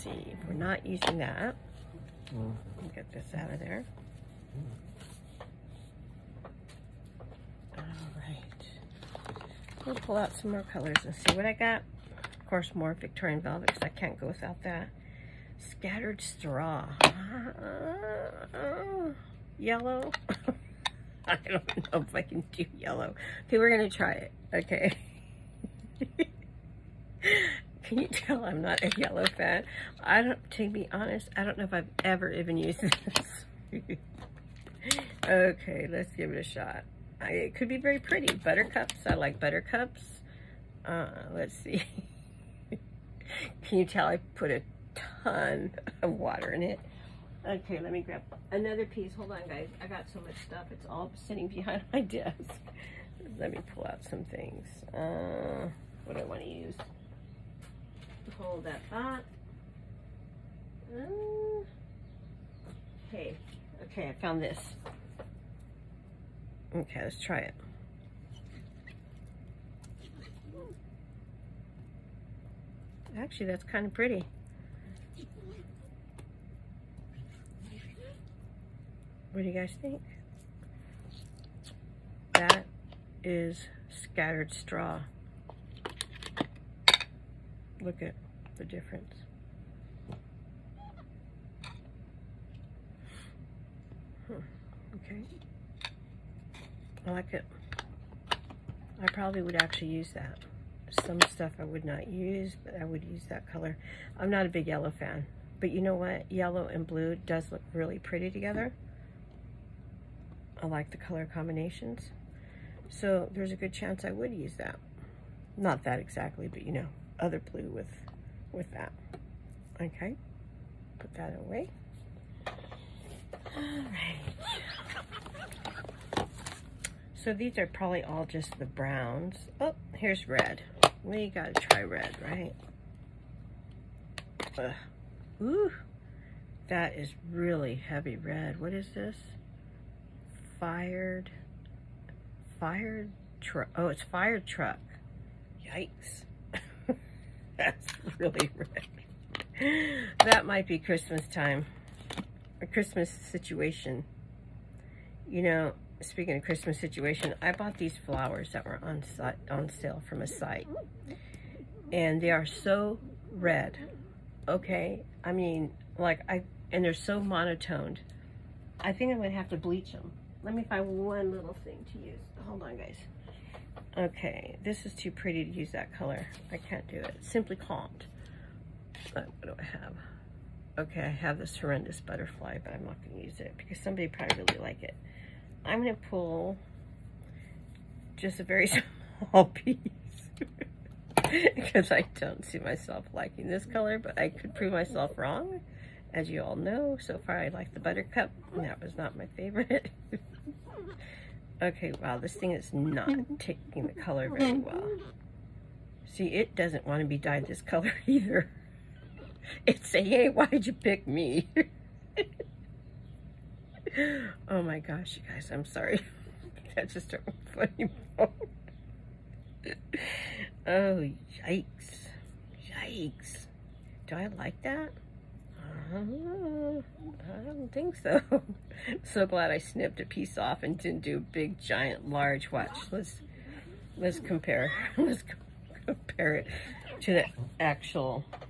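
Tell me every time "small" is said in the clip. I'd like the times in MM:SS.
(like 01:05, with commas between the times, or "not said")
03:09.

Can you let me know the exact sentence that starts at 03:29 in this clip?
It's saying, hey, why'd you pick me?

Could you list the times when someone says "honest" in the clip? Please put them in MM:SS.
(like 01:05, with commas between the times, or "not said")
00:30.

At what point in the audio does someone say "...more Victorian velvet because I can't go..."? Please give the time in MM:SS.
00:12.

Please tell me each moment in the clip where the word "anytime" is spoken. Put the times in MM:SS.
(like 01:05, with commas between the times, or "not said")
not said.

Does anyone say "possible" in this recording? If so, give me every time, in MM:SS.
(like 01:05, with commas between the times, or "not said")
not said.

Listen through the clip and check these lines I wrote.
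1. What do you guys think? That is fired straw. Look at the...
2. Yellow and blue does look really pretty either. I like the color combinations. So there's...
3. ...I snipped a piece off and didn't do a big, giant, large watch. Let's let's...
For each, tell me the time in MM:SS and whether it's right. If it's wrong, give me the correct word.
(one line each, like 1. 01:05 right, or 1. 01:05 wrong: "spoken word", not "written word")
1. 01:19 wrong: "scattered", not "fired"
2. 01:46 wrong: "together", not "either"
3. 03:49 right.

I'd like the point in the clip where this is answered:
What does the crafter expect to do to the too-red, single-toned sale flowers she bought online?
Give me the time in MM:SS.
02:49.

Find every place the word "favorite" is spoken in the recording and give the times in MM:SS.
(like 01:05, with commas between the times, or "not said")
03:19.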